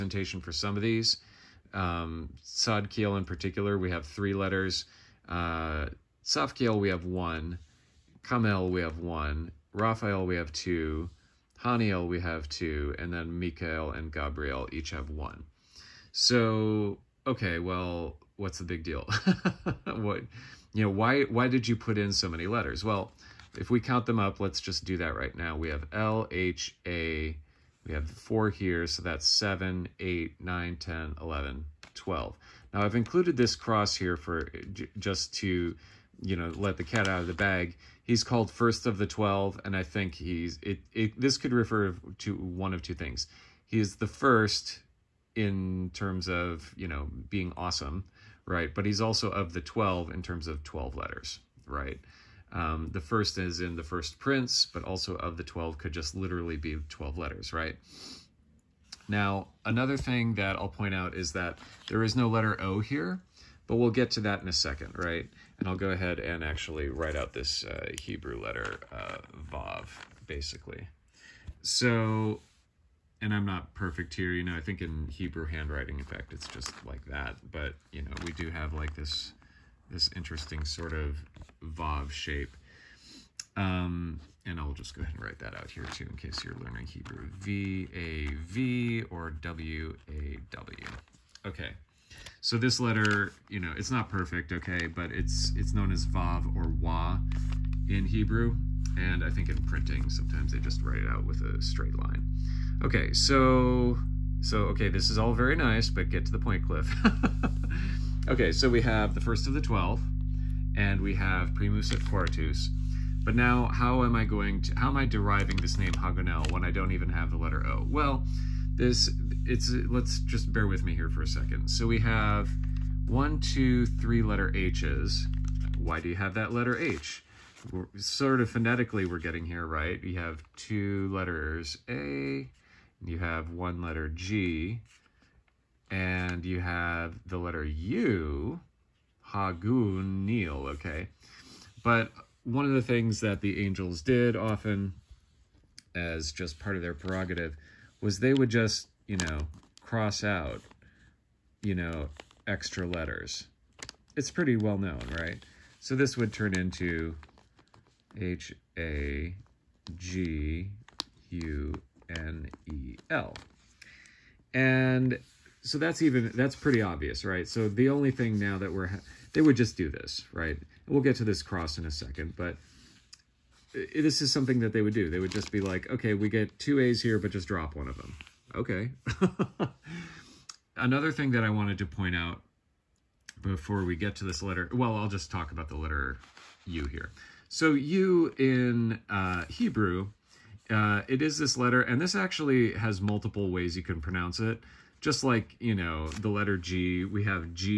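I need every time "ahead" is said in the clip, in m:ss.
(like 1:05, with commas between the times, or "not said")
1:05, 1:25.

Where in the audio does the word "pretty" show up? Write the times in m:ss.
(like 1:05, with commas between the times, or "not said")
2:34, 2:46.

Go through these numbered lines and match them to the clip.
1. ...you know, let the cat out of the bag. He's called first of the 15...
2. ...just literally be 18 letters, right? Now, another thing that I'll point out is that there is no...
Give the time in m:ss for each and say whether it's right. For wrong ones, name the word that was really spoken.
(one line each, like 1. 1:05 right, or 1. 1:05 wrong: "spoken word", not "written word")
1. 0:36 wrong: "12", not "15"
2. 0:55 wrong: "12", not "18".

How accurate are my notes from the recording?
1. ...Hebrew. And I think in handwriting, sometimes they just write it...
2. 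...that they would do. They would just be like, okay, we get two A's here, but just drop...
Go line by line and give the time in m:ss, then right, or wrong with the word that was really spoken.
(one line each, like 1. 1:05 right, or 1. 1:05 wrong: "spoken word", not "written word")
1. 1:38 wrong: "printing", not "handwriting"
2. 2:54 right.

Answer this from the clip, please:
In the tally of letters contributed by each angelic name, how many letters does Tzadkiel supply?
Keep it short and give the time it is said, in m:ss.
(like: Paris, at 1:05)
3, at 0:04.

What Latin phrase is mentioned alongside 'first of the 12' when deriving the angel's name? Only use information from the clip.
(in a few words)
Primus et Quartus.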